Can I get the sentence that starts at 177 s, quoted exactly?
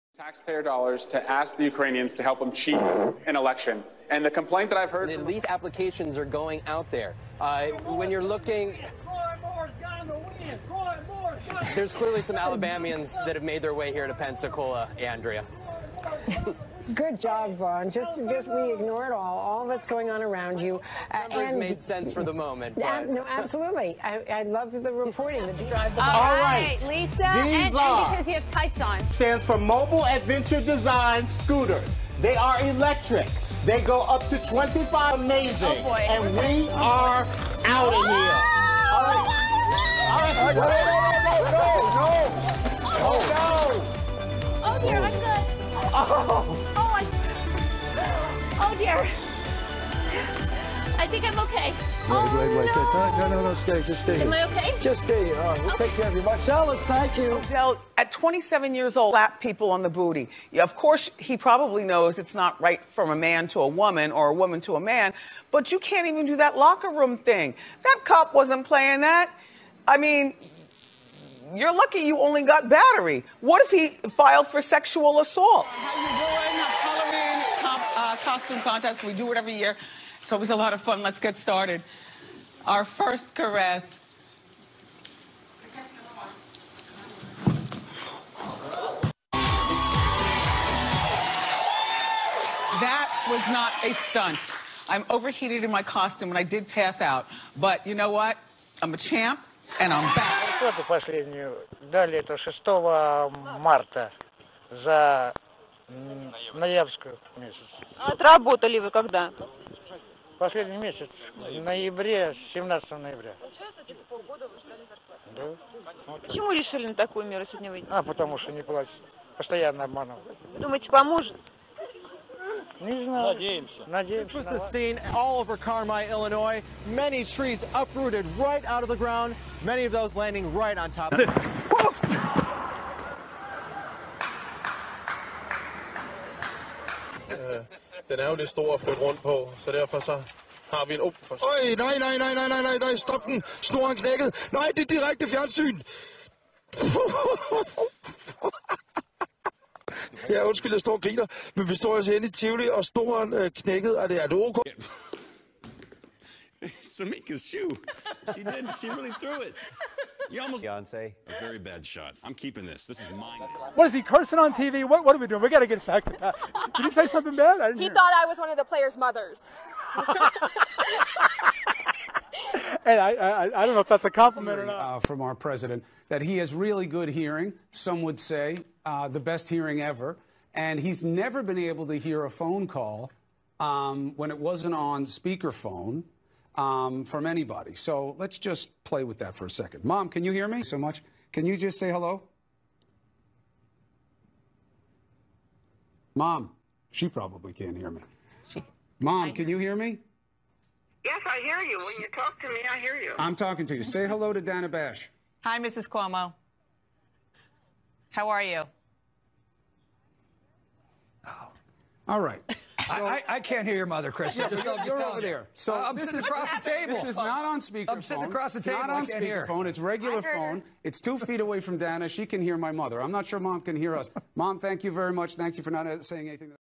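Some would say uh, the best hearing ever.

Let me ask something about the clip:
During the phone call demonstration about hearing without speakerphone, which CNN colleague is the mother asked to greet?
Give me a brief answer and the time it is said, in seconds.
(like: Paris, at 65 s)
Dana Bash, at 204 s.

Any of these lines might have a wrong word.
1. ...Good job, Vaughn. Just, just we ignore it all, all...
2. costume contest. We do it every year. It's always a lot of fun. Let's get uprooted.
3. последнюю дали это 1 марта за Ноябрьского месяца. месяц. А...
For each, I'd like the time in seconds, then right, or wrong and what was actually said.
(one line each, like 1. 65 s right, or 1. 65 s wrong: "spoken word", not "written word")
1. 16 s right
2. 78 s wrong: "started", not "uprooted"
3. 100 s wrong: "6", not "1".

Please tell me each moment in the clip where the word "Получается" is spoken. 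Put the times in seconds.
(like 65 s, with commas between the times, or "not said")
113 s.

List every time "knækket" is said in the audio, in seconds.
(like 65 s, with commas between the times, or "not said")
143 s, 153 s.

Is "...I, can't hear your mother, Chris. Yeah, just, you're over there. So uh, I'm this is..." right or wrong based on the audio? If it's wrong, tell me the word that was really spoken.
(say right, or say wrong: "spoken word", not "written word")
right.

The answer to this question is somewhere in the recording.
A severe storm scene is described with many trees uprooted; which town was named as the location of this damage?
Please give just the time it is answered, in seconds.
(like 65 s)
125 s.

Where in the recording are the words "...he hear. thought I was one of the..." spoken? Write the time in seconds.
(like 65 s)
167 s.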